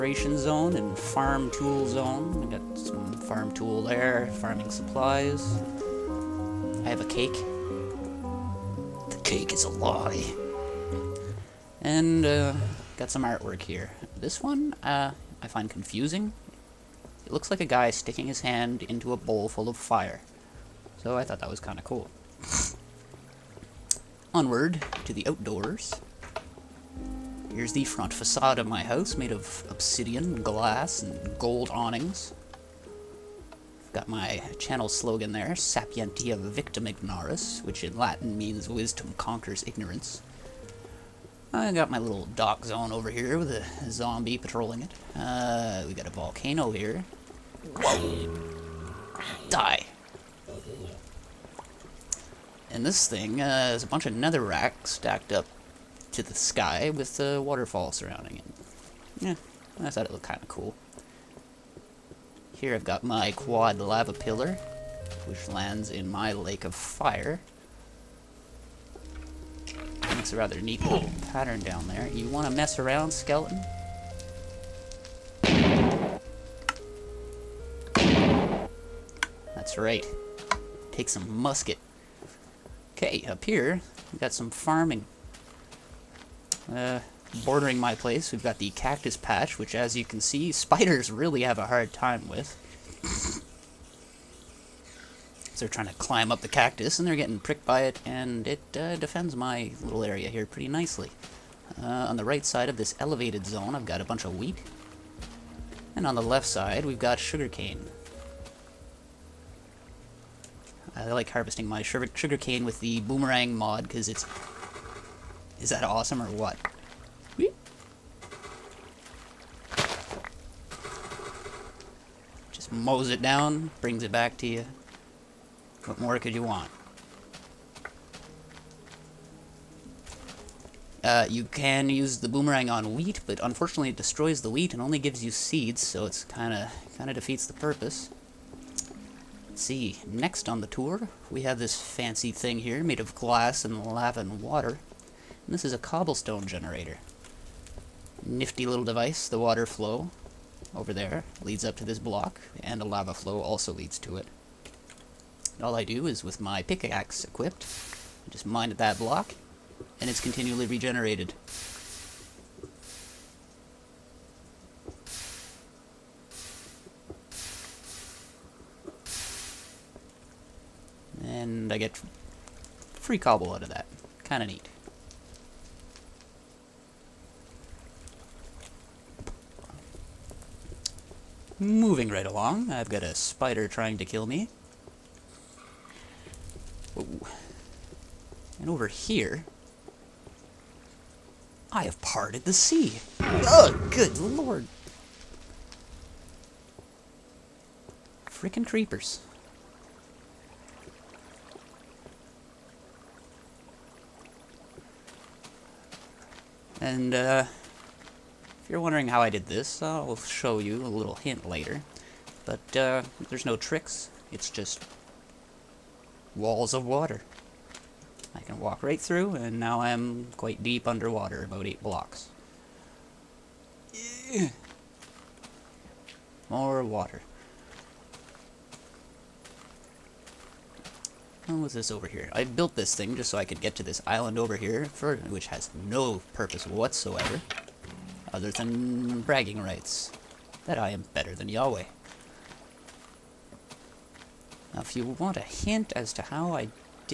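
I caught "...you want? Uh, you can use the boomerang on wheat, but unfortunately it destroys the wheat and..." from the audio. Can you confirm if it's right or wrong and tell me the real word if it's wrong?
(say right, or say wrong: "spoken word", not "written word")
right.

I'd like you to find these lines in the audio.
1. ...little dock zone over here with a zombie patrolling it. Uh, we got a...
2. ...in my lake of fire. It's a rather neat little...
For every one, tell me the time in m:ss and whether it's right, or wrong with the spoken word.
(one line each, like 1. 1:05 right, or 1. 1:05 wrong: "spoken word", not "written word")
1. 0:41 right
2. 1:05 right.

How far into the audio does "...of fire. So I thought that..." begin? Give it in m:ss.
0:19.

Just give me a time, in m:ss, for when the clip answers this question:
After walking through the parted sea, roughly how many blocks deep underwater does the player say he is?
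3:41.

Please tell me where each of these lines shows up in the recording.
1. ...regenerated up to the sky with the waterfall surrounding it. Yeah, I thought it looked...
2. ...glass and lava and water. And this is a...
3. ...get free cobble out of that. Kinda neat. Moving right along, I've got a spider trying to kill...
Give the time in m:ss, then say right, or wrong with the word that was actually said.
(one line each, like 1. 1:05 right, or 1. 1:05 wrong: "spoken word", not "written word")
1. 0:54 wrong: "stacked", not "regenerated"
2. 2:23 right
3. 2:51 right.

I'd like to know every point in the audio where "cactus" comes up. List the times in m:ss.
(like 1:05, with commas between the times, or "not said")
1:28, 1:36.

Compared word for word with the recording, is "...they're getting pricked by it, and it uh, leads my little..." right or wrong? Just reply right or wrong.
wrong.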